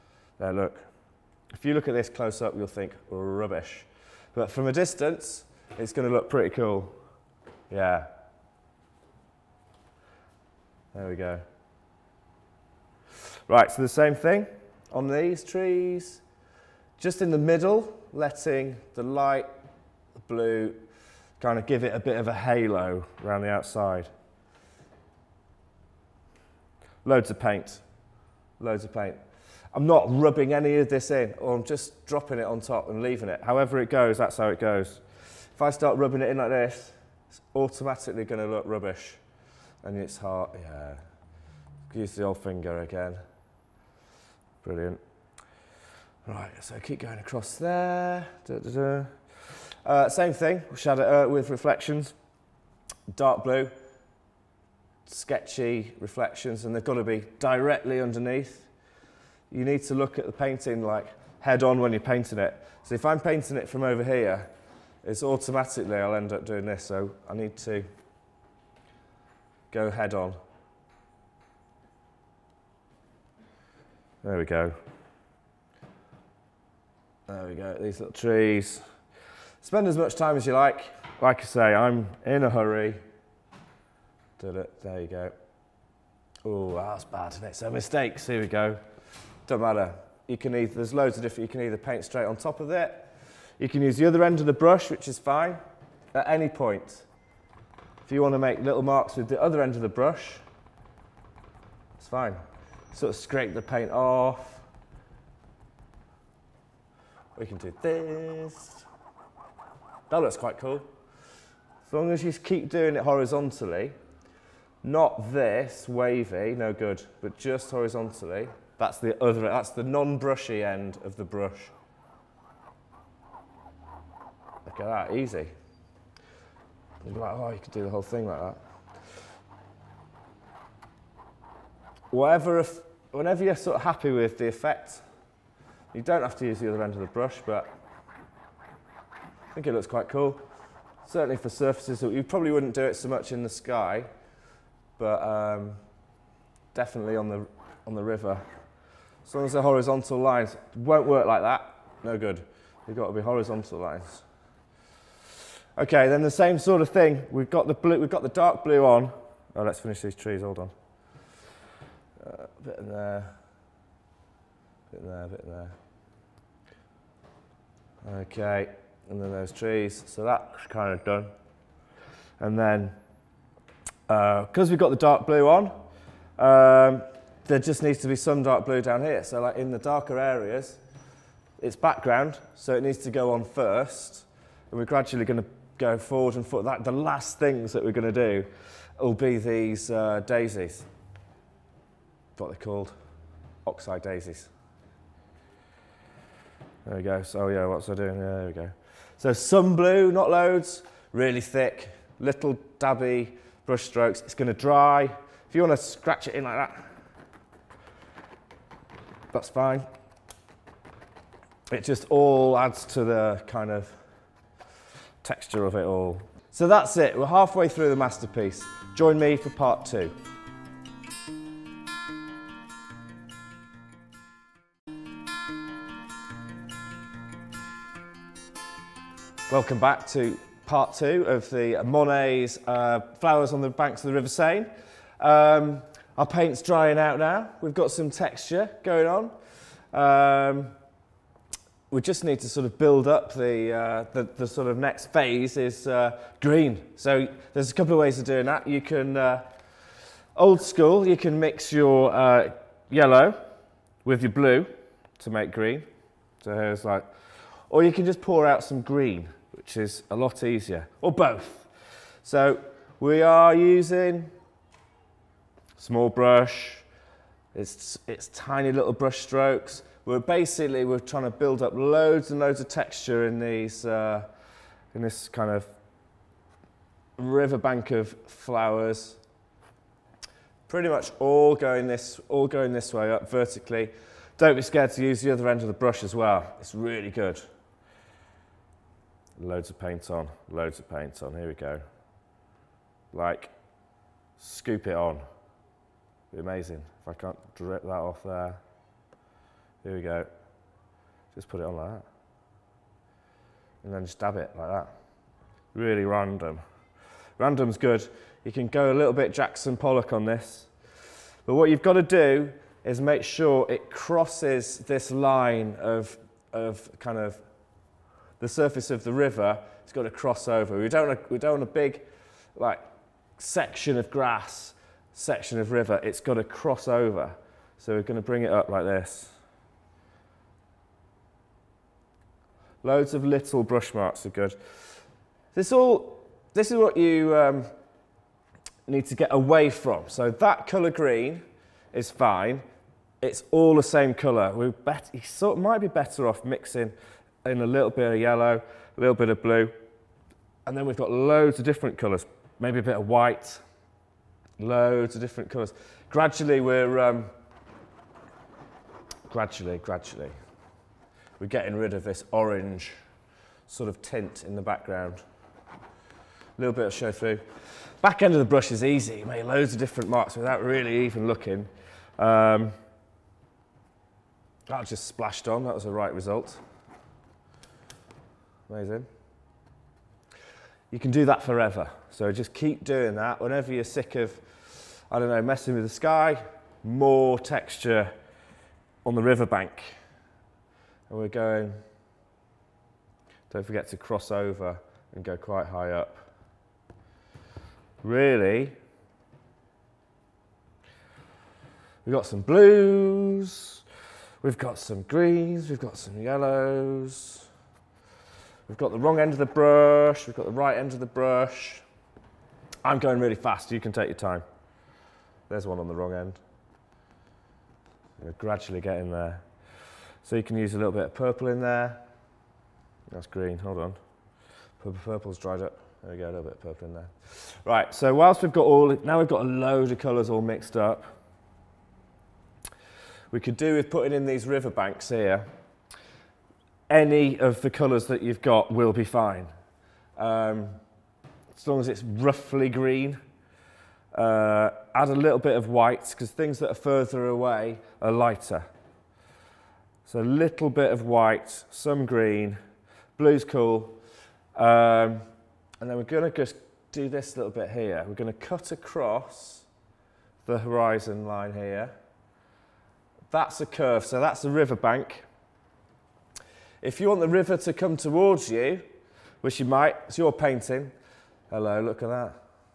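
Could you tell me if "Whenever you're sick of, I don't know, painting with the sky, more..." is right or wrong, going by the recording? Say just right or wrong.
wrong.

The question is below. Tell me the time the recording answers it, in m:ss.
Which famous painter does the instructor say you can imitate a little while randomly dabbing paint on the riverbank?
5:09.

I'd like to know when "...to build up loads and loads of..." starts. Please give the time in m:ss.
4:31.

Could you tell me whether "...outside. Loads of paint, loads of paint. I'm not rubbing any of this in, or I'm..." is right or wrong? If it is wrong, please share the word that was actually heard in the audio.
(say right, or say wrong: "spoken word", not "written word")
right.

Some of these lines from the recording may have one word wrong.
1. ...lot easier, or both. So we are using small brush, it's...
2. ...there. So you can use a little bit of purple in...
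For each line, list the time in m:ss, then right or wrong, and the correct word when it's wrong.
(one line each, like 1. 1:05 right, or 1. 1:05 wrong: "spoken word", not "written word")
1. 4:20 right
2. 6:59 right.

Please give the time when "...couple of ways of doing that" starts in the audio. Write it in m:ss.
4:07.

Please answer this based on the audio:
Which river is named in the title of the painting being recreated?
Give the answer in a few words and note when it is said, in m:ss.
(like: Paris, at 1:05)
River Seine, at 3:54.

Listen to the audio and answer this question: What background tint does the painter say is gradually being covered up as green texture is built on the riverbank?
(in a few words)
Orange.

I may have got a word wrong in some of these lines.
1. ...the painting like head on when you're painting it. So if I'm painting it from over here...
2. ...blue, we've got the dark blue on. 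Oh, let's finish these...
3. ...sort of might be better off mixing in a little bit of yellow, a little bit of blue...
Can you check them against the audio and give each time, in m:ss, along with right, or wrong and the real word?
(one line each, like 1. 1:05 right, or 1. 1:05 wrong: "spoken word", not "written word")
1. 1:00 right
2. 2:37 right
3. 5:45 right.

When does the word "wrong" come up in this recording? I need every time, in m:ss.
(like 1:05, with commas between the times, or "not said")
6:48, 6:55.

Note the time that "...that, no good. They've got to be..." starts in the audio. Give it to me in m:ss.
2:31.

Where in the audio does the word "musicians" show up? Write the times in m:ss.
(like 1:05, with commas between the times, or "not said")
not said.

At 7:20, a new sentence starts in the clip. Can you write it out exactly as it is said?
Um, as long as it's roughly green.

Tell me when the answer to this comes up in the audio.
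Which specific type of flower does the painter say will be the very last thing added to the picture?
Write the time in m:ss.
3:13.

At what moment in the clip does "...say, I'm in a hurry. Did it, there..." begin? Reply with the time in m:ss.
1:21.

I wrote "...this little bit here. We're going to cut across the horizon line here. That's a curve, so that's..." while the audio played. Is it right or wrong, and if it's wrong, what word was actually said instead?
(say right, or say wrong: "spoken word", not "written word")
right.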